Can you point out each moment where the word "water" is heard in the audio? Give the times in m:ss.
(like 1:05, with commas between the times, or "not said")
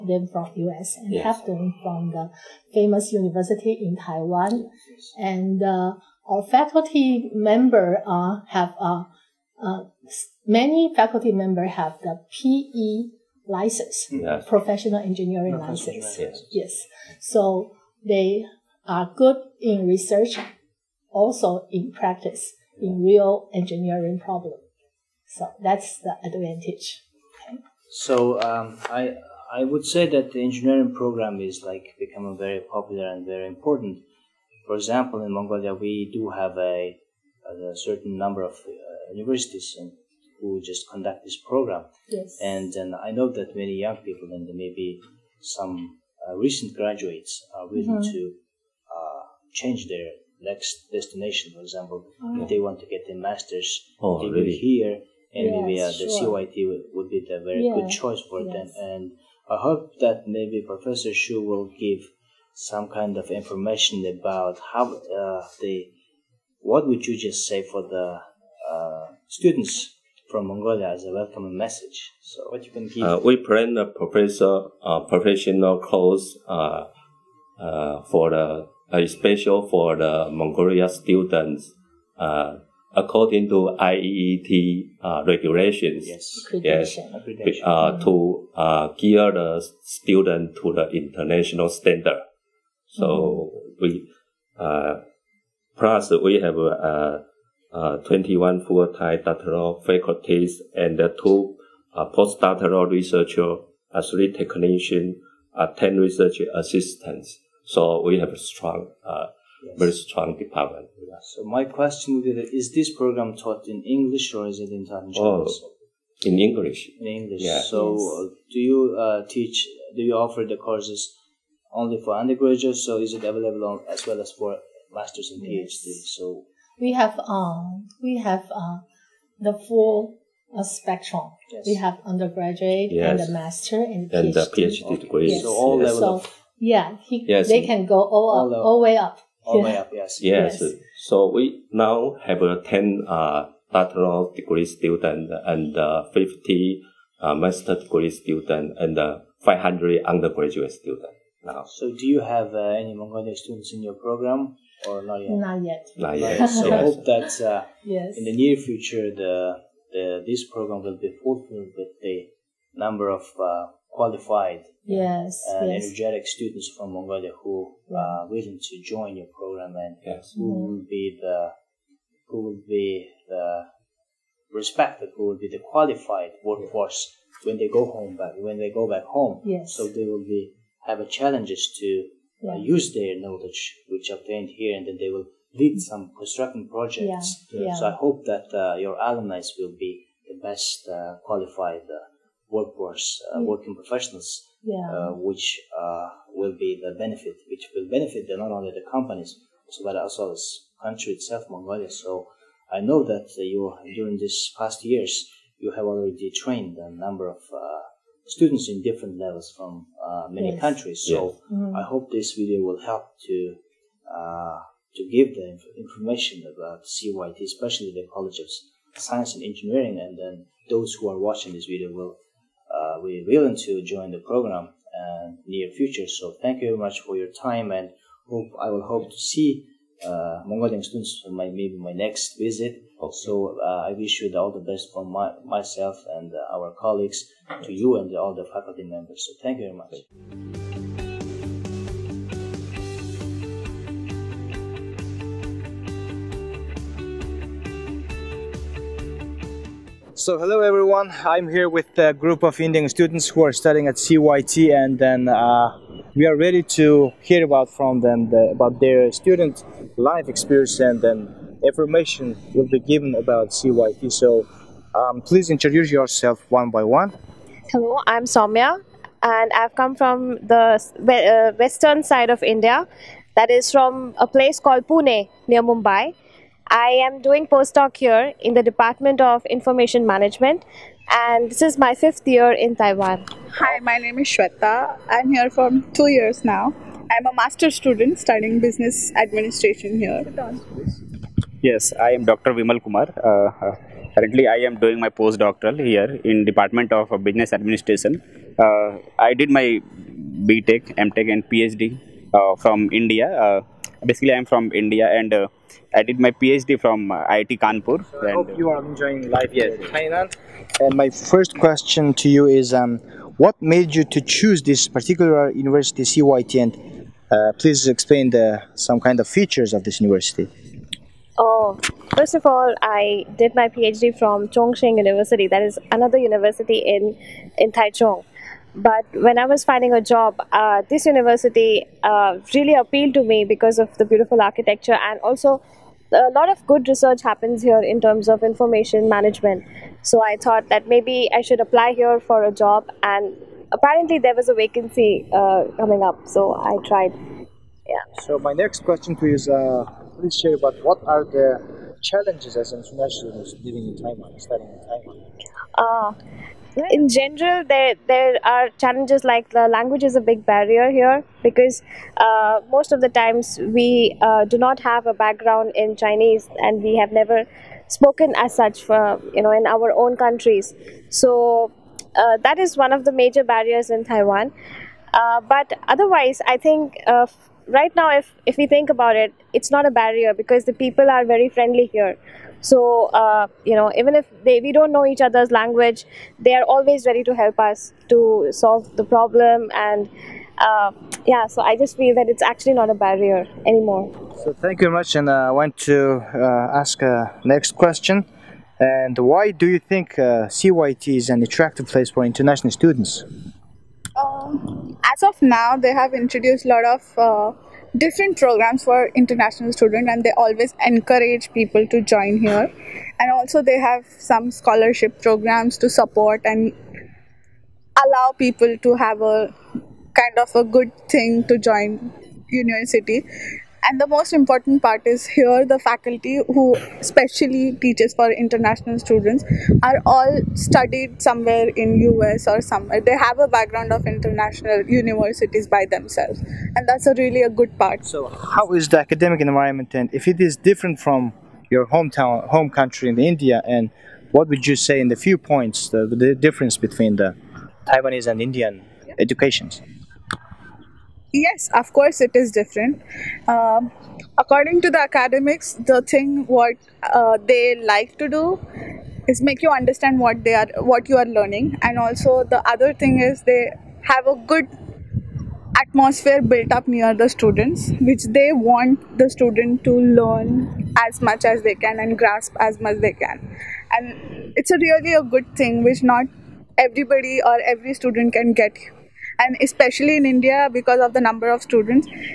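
not said.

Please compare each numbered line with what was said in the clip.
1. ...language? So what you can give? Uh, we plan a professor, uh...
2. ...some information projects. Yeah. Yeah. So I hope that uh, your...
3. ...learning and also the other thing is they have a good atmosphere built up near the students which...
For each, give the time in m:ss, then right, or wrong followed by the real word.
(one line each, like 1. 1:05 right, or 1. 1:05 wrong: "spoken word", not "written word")
1. 1:11 wrong: "message", not "language"
2. 3:05 wrong: "construction", not "information"
3. 7:41 right.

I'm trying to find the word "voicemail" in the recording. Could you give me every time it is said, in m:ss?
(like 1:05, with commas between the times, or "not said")
not said.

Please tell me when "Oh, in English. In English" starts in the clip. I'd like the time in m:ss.
1:55.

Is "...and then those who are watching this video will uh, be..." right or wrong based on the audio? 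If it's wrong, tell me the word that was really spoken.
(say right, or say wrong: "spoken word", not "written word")
right.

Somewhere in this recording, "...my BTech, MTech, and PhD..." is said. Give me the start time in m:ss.
4:59.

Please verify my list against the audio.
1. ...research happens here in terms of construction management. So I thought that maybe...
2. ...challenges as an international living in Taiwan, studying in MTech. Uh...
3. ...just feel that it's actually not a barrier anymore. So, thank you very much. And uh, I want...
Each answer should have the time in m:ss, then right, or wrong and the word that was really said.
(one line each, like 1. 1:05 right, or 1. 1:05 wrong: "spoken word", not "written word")
1. 5:36 wrong: "information", not "construction"
2. 5:52 wrong: "Taiwan", not "MTech"
3. 6:31 right.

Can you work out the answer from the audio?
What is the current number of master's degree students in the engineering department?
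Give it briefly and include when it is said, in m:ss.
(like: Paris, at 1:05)
50, at 2:26.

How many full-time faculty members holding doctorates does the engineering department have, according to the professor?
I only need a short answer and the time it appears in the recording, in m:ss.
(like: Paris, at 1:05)
21, at 1:37.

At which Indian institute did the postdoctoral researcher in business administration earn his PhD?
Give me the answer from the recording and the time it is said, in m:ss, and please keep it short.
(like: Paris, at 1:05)
IIT Kanpur, at 5:07.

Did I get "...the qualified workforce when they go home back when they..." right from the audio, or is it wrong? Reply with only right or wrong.
right.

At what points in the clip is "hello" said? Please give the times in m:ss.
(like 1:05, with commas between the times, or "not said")
4:10, 4:27.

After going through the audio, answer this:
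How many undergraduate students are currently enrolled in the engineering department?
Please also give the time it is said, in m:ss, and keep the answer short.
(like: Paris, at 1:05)
500, at 2:29.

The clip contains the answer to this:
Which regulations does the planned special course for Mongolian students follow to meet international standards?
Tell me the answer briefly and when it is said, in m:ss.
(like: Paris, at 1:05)
IEET, at 1:23.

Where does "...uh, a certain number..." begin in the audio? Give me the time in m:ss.
0:37.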